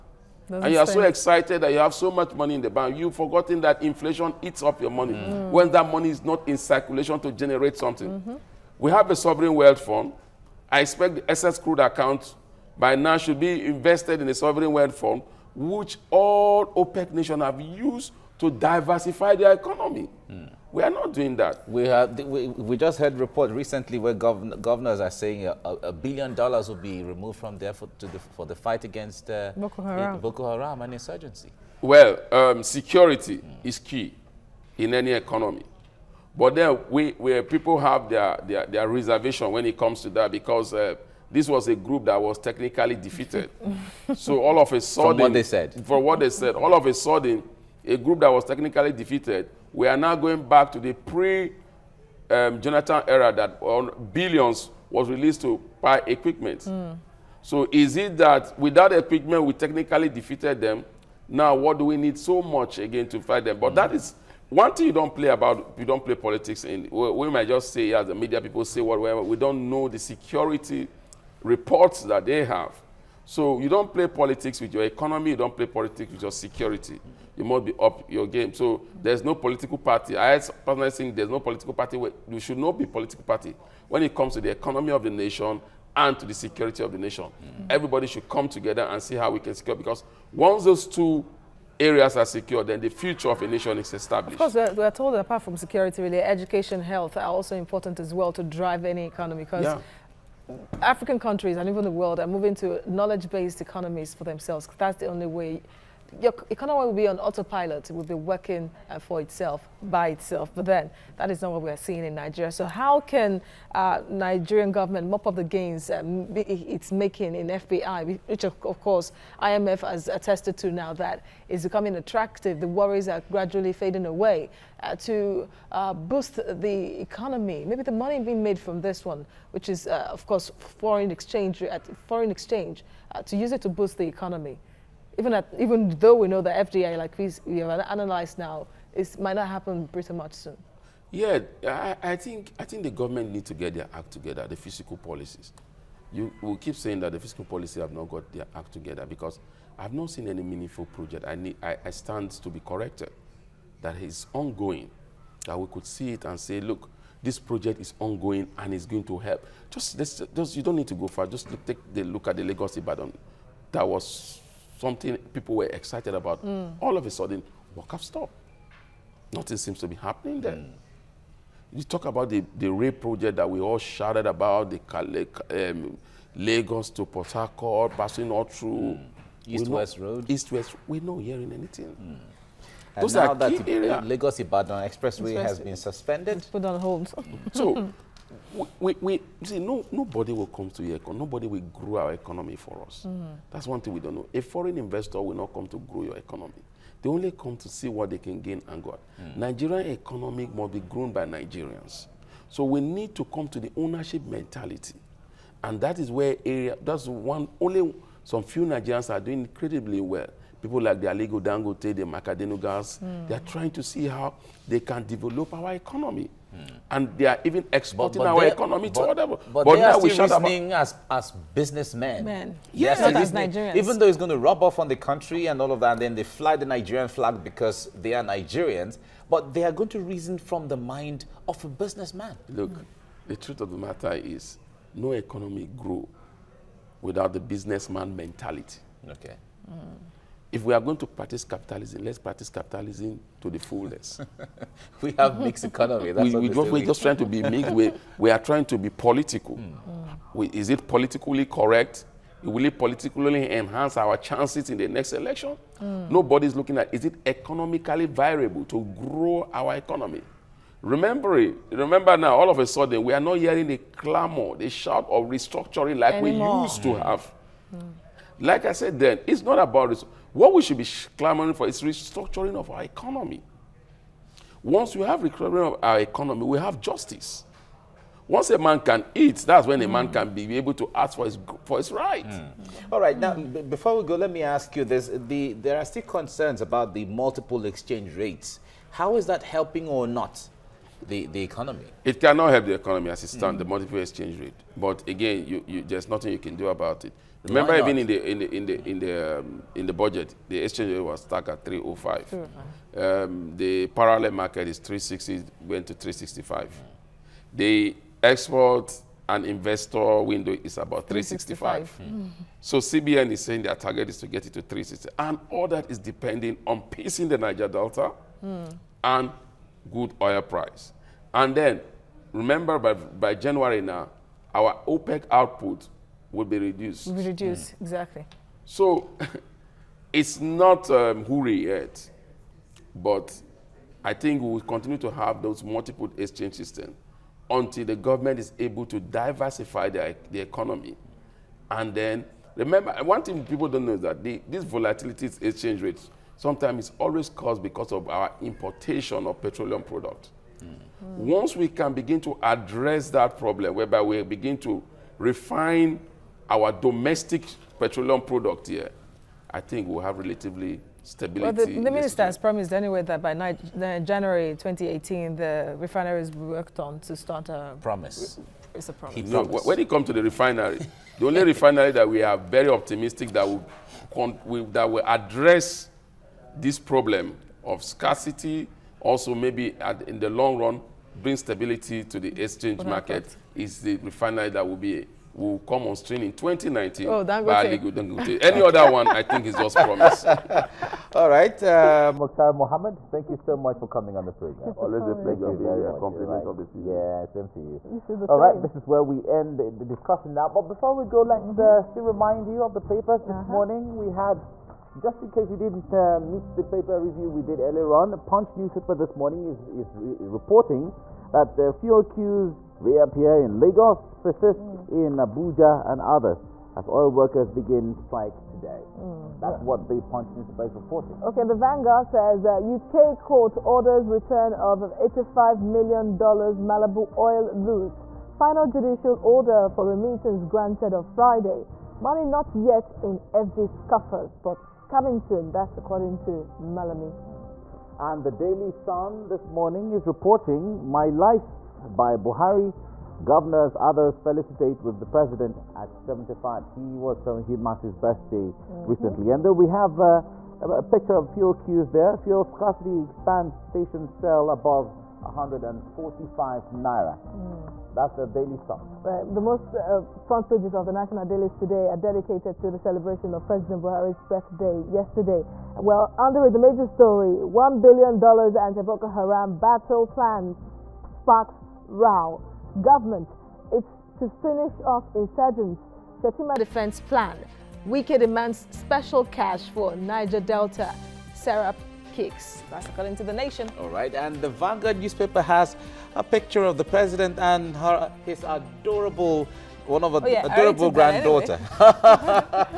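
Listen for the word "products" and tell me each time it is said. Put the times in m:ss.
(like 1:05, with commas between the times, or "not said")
5:49, 5:58.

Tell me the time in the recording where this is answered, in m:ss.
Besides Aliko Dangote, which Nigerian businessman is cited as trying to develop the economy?
3:32.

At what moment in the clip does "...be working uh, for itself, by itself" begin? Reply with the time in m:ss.
1:48.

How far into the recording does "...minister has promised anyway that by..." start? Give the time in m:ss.
6:01.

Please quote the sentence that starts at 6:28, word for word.
Any other one, I think, is just promise.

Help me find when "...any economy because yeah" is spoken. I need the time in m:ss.
1:38.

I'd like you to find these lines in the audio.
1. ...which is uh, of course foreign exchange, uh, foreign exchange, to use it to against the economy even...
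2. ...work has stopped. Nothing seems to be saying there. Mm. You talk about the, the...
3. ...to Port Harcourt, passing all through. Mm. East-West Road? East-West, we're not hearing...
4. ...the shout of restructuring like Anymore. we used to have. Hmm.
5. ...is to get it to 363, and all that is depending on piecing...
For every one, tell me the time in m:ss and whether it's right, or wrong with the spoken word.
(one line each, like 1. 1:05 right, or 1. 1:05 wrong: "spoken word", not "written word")
1. 2:09 wrong: "boost", not "against"
2. 2:47 wrong: "happening", not "saying"
3. 2:56 right
4. 4:24 right
5. 5:14 wrong: "360", not "363".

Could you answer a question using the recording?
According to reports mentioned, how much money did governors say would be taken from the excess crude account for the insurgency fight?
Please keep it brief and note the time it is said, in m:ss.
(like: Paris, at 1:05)
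a billion dollars, at 0:25.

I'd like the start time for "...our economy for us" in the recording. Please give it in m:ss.
3:12.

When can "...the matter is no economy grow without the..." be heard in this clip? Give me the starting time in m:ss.
3:53.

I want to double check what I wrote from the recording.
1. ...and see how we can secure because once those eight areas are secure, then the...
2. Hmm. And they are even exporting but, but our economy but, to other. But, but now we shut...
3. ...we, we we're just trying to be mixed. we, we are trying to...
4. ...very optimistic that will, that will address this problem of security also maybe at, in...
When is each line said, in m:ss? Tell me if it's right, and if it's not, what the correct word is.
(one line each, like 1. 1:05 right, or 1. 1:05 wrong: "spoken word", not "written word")
1. 1:28 wrong: "two", not "eight"
2. 3:36 right
3. 4:06 right
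4. 6:12 wrong: "scarcity", not "security".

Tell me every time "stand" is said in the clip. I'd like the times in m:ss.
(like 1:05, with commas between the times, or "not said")
2:31, 4:53.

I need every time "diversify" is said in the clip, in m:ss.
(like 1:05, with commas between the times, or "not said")
0:18, 5:38.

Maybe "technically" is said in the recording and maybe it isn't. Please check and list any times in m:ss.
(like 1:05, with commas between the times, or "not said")
0:42, 0:48, 0:59.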